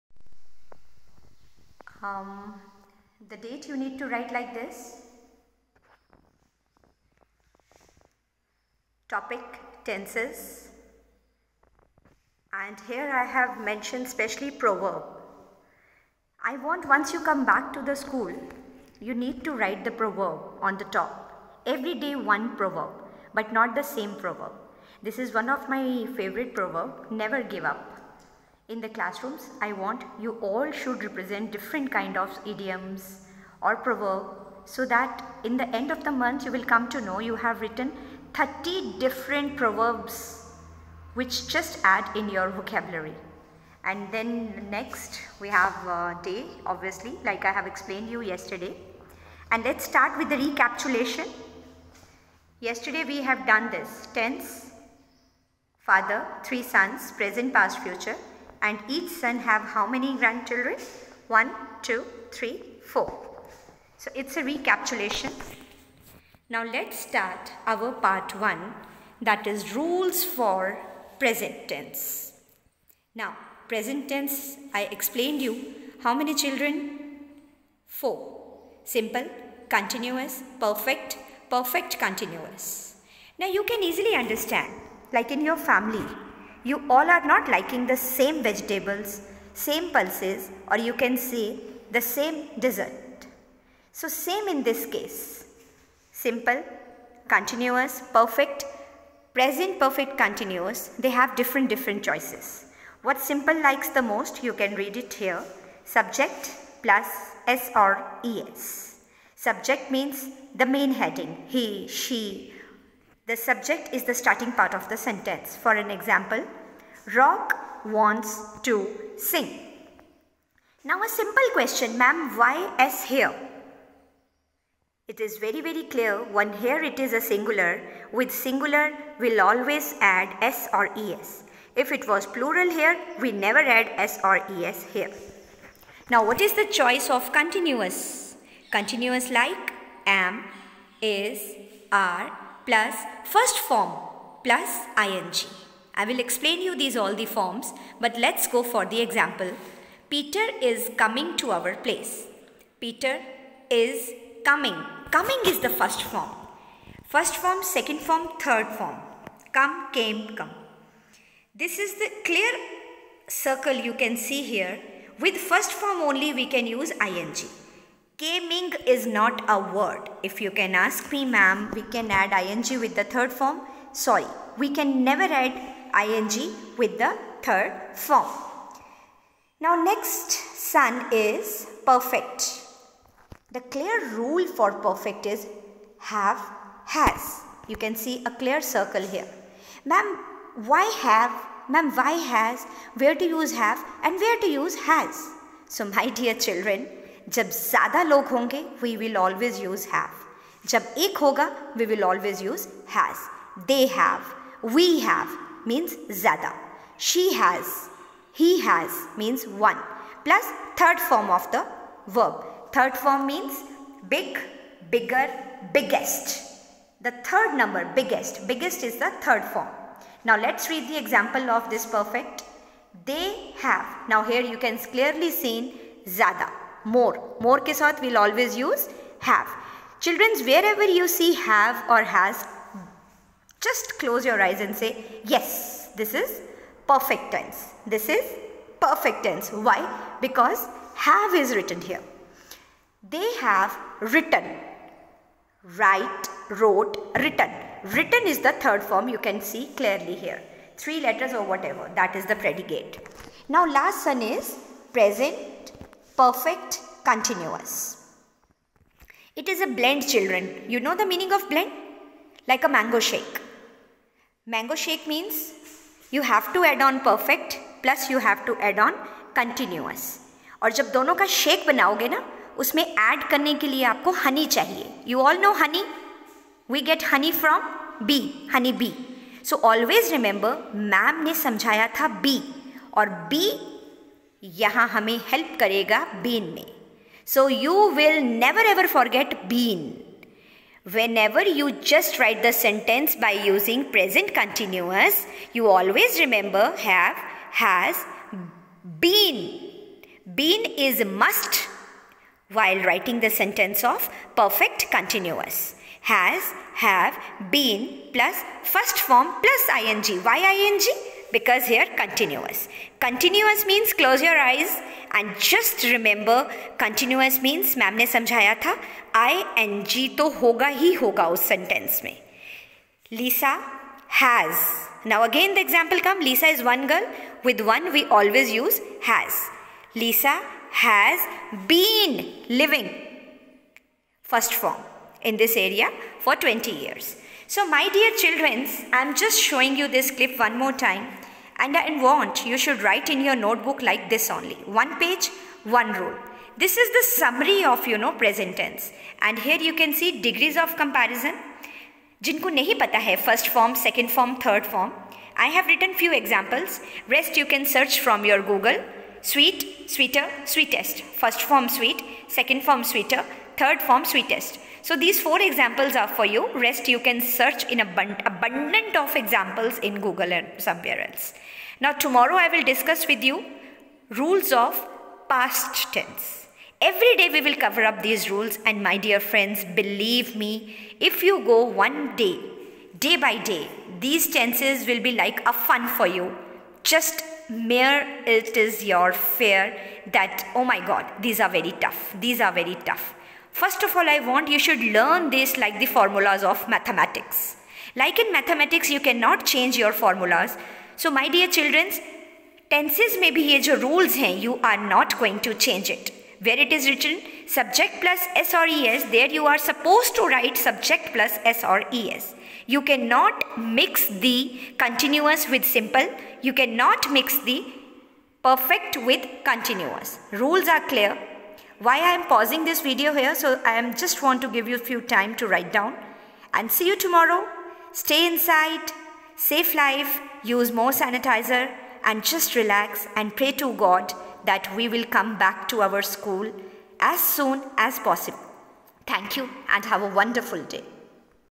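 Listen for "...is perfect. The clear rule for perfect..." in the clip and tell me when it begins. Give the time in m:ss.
3:01.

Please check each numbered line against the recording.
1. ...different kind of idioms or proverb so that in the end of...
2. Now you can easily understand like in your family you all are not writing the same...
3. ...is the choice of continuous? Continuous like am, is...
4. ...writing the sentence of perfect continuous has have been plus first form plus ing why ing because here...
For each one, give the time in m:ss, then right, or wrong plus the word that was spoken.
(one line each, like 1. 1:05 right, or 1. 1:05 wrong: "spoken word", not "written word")
1. 0:31 right
2. 1:23 wrong: "liking", not "writing"
3. 2:16 right
4. 5:02 right.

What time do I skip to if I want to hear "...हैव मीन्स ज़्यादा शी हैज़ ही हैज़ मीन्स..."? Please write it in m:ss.
3:24.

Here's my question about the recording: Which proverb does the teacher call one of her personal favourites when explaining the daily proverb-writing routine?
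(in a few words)
Never give up.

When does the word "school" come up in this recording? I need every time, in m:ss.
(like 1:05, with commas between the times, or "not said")
0:17, 7:16.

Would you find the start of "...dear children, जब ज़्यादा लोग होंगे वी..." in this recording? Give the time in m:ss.
3:16.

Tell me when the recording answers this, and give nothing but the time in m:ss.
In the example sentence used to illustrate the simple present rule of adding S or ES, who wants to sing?
1:57.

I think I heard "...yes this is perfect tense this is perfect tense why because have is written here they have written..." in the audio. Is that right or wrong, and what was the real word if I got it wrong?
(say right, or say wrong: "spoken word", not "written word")
right.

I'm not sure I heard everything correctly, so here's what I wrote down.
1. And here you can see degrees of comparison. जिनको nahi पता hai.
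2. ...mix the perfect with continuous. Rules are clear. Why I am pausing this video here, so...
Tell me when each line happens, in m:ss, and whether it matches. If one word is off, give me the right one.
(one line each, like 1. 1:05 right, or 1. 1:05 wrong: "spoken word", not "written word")
1. 5:49 right
2. 6:57 right.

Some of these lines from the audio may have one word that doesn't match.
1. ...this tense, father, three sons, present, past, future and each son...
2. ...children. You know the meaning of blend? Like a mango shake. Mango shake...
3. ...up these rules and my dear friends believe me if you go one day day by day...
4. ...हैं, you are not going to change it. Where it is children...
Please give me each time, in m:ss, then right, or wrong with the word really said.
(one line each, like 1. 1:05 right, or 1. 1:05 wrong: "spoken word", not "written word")
1. 0:53 right
2. 4:20 right
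3. 6:17 right
4. 6:44 wrong: "written", not "children".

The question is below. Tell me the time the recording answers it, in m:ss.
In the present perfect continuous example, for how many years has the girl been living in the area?
5:36.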